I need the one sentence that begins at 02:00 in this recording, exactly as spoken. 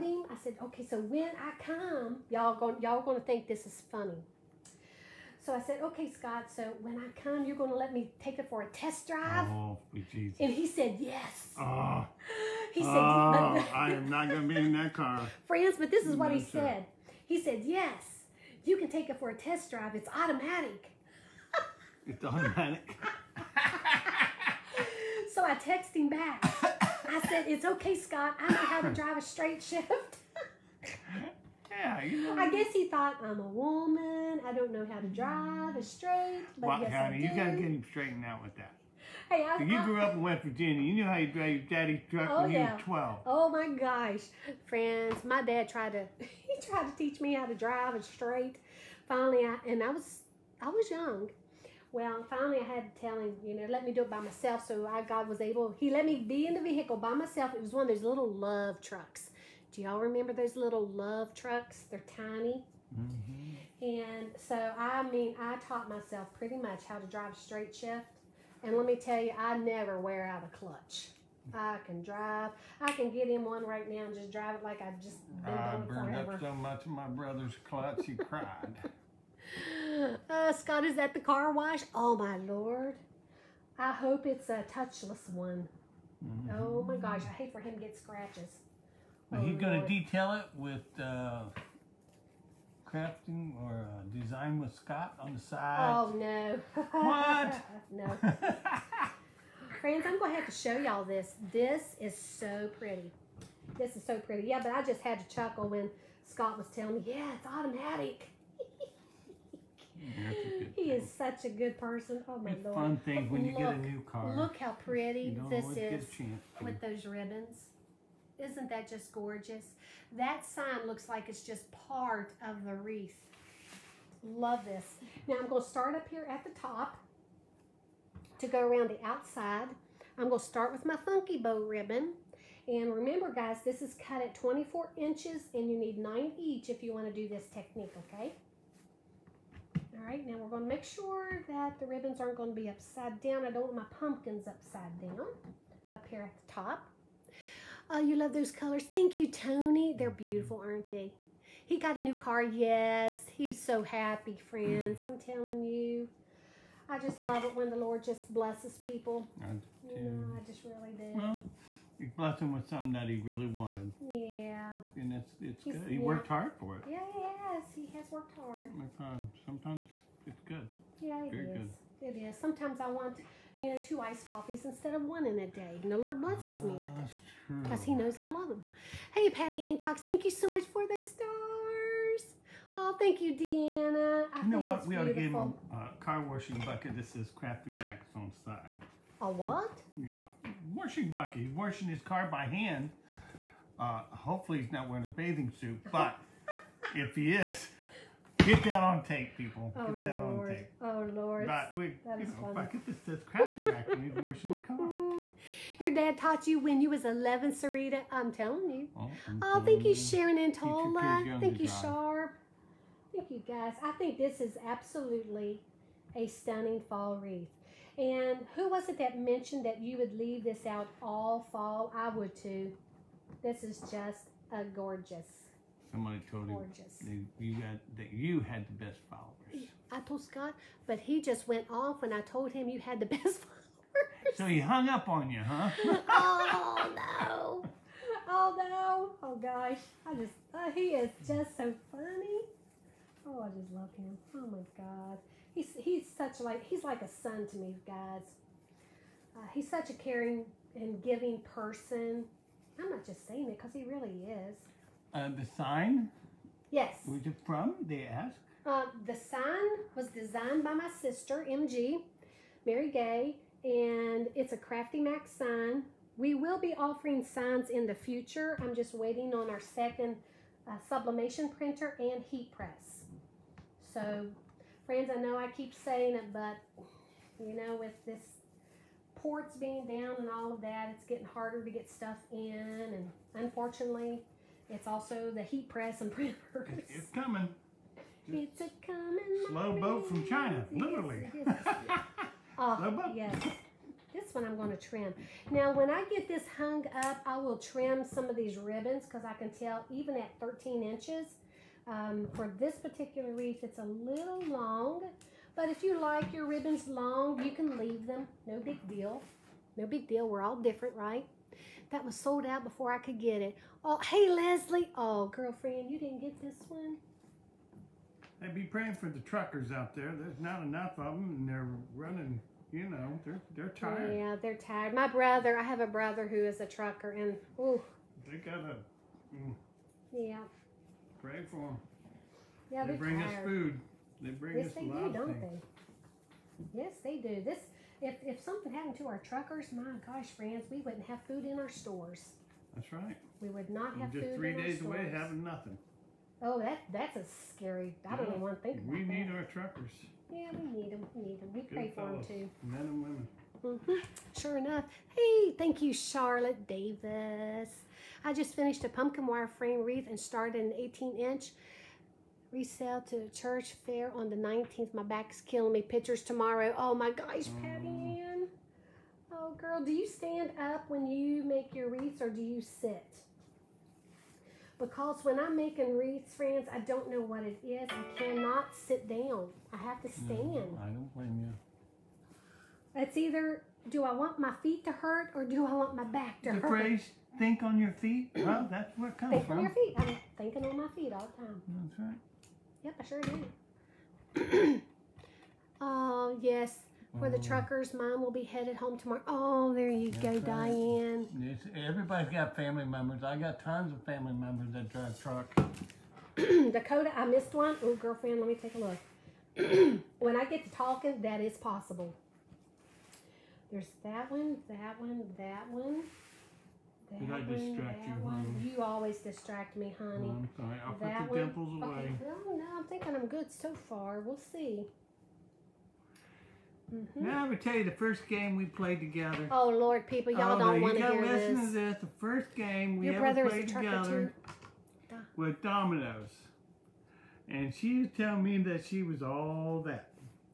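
That sign looks like it's just part of the wreath.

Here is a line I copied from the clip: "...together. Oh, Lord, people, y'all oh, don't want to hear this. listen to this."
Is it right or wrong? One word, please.
right.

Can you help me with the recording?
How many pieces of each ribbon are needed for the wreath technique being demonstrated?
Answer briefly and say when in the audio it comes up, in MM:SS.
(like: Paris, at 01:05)
9, at 02:15.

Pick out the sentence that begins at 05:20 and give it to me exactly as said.
There's not enough of them, and they're running, you know, they're, they're tired.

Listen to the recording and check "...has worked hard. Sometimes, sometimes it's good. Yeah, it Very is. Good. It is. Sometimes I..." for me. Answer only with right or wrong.
right.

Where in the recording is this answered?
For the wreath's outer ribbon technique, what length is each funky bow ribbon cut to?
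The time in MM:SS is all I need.
02:14.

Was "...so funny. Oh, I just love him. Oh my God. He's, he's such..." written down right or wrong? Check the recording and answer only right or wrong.
right.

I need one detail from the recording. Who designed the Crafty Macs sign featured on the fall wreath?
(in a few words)
Mary Gay.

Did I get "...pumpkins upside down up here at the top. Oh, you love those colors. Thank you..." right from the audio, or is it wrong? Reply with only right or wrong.
right.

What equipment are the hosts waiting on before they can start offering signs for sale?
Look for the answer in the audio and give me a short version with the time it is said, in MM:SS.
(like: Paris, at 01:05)
Sublimation printer and heat press, at 04:30.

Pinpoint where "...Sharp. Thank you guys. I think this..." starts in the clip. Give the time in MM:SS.
03:31.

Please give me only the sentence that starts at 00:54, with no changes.
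So I, God was able, he let me be in the vehicle by myself.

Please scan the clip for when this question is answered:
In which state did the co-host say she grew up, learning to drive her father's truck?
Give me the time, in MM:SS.
00:40.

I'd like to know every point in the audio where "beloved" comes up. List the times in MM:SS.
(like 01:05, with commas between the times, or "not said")
not said.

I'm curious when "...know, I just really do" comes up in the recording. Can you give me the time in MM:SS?
02:40.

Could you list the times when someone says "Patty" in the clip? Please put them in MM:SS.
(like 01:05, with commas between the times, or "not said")
02:59, 06:07.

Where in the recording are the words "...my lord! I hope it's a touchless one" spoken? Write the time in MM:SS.
01:22.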